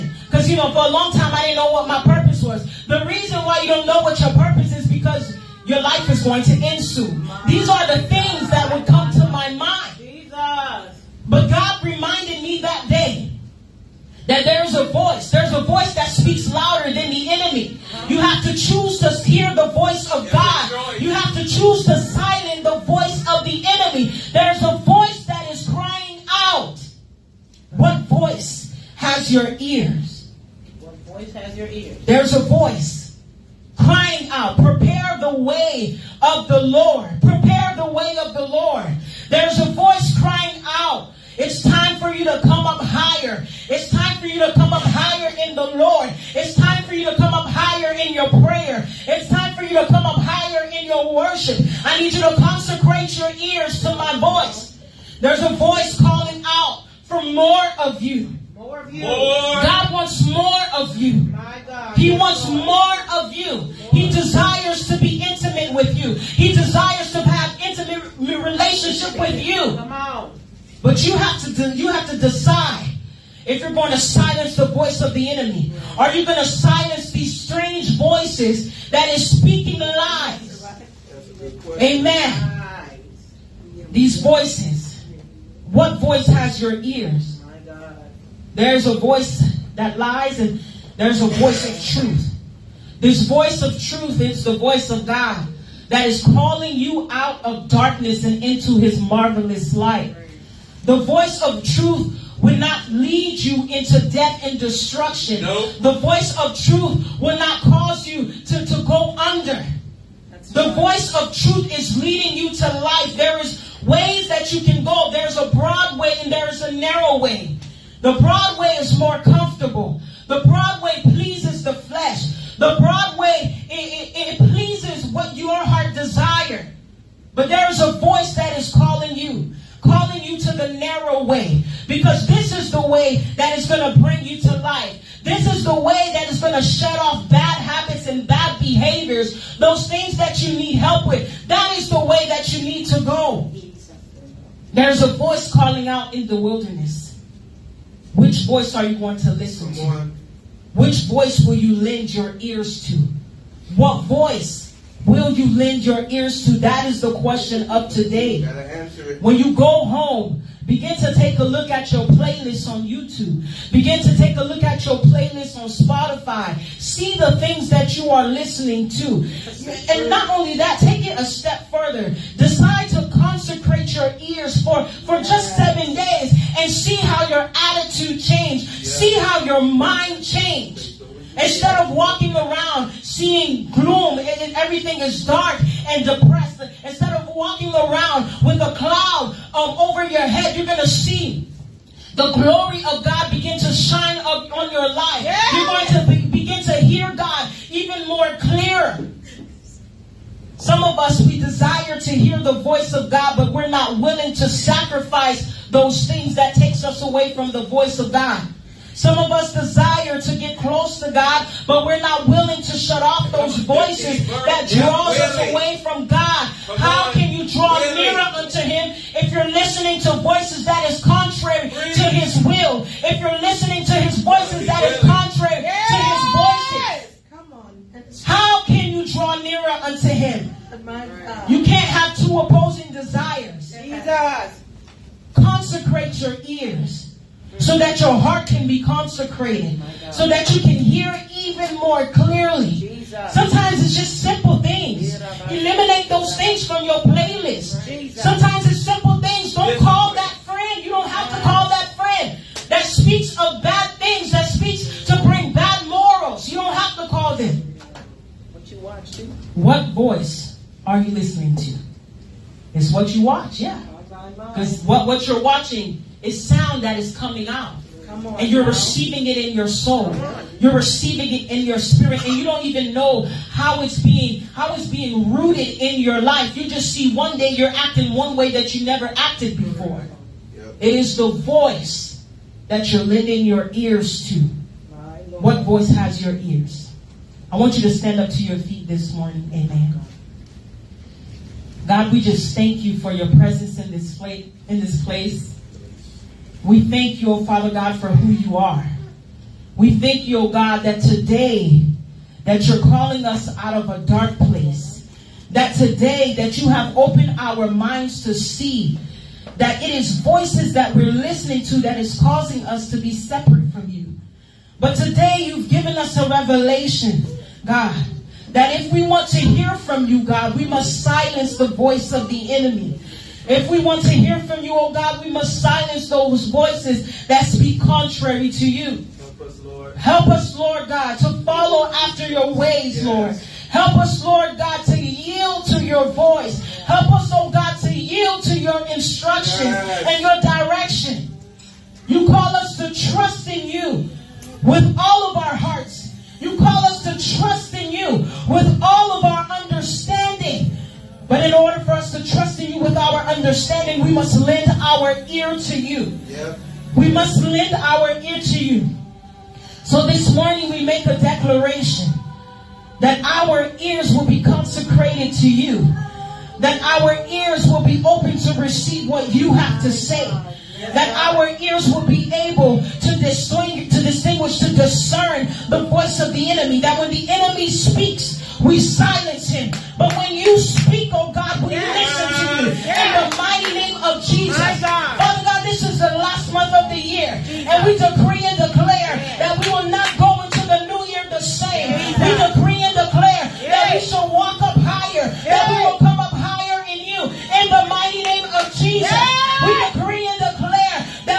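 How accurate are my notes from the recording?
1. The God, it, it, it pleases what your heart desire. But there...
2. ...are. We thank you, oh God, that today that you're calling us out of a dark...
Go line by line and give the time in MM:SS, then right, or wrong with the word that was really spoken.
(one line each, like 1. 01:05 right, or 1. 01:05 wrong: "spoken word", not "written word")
1. 02:02 wrong: "Broadway", not "God"
2. 04:58 right.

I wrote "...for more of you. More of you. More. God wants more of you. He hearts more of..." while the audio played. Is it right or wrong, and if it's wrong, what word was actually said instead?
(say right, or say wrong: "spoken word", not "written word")
wrong: "wants", not "hearts".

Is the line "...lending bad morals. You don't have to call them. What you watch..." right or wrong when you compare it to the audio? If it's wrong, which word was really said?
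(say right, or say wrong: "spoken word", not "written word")
wrong: "bring", not "lending".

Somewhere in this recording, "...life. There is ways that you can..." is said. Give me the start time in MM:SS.
01:52.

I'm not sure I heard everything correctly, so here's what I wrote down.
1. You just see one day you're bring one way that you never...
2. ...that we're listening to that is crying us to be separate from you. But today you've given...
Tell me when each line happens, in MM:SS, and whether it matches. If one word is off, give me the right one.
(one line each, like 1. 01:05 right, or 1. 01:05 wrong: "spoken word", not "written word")
1. 04:36 wrong: "acting", not "bring"
2. 05:10 wrong: "causing", not "crying".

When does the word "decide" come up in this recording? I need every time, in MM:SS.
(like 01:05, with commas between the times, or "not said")
01:12, 02:52.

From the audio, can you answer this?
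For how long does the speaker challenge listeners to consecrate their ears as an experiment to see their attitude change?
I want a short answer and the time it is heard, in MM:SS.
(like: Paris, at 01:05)
7 days, at 02:55.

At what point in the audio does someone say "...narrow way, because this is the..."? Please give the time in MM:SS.
02:10.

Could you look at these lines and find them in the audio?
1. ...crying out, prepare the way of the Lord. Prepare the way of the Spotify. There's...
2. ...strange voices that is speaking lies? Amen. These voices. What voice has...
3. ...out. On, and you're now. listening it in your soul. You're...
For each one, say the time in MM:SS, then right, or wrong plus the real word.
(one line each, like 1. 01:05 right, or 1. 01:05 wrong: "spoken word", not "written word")
1. 00:33 wrong: "Lord", not "Spotify"
2. 01:17 right
3. 04:27 wrong: "receiving", not "listening".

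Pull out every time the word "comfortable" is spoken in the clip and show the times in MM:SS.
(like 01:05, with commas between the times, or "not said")
01:59.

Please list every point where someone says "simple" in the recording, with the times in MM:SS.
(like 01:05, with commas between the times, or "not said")
04:04, 04:08.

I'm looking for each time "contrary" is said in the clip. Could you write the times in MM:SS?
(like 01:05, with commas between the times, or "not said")
03:41, 03:45, 05:27.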